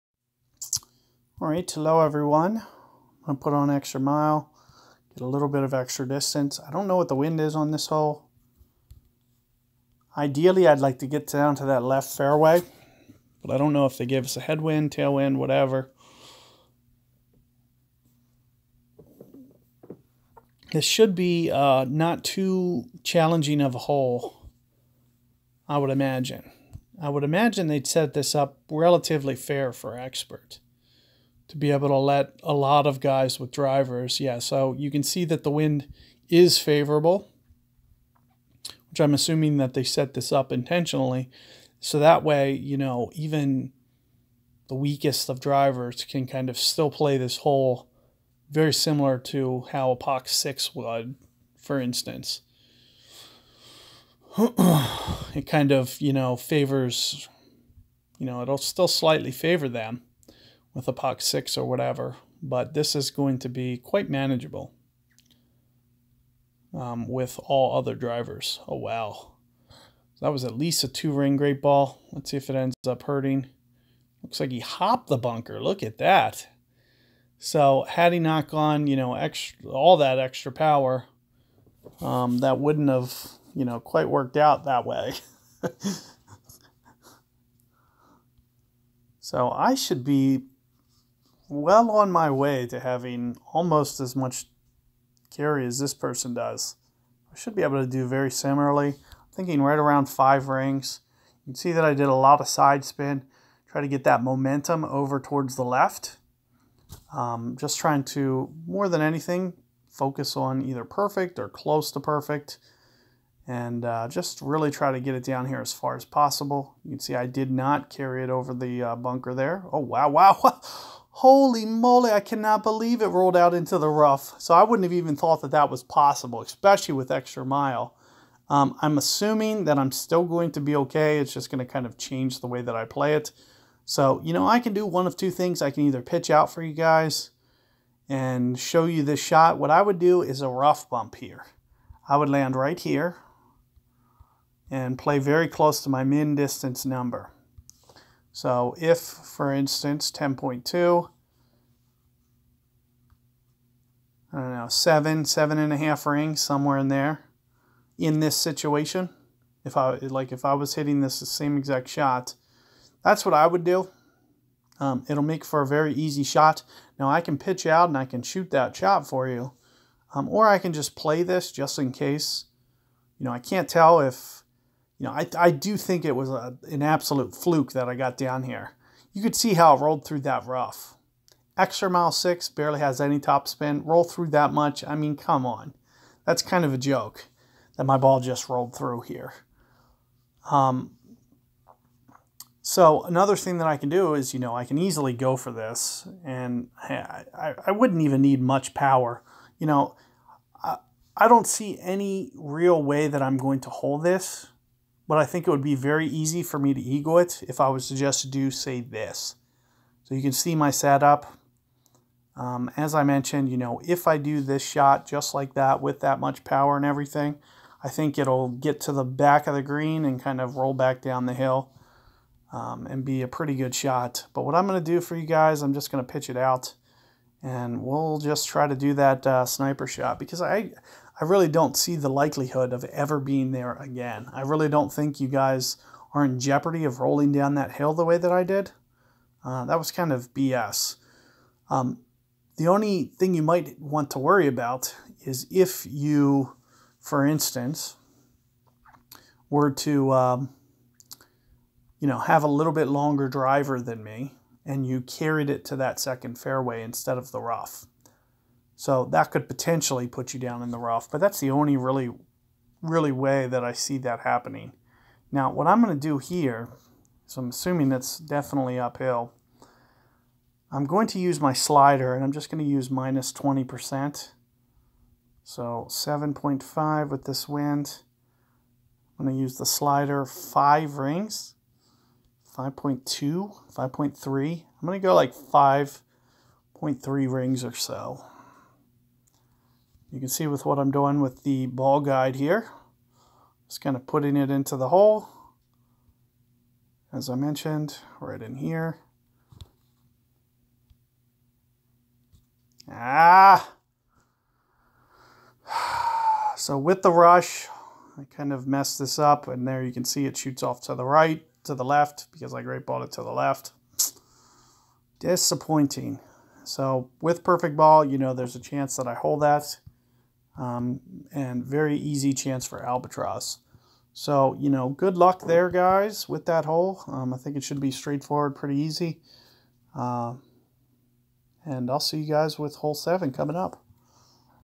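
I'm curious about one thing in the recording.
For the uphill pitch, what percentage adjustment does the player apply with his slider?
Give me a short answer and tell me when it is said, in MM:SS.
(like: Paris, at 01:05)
minus 20%, at 04:32.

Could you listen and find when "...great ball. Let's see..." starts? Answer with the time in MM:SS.
01:11.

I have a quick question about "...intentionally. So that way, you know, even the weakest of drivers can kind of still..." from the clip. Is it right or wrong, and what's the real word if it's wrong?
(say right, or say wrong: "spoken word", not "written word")
right.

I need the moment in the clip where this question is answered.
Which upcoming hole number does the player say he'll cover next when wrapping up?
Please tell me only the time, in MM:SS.
05:32.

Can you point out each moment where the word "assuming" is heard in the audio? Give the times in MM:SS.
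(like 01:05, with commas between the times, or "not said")
00:39, 02:08, 04:27.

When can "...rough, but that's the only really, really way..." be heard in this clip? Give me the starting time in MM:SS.
04:20.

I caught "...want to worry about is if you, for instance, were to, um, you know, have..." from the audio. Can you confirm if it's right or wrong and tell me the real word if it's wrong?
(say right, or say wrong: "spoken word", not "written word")
right.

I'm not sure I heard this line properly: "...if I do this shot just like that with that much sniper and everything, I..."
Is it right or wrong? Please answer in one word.
wrong.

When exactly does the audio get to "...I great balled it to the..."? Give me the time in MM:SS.
05:12.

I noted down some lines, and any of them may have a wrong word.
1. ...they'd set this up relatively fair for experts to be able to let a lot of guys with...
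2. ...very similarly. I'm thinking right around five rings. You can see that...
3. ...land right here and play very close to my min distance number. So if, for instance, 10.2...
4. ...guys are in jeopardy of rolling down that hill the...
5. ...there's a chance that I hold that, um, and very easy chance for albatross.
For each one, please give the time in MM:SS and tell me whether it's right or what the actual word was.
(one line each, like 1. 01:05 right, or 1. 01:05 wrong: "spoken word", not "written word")
1. 00:27 right
2. 01:38 right
3. 02:22 right
4. 03:55 right
5. 05:18 right.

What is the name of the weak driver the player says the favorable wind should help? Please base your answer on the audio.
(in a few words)
POC 6.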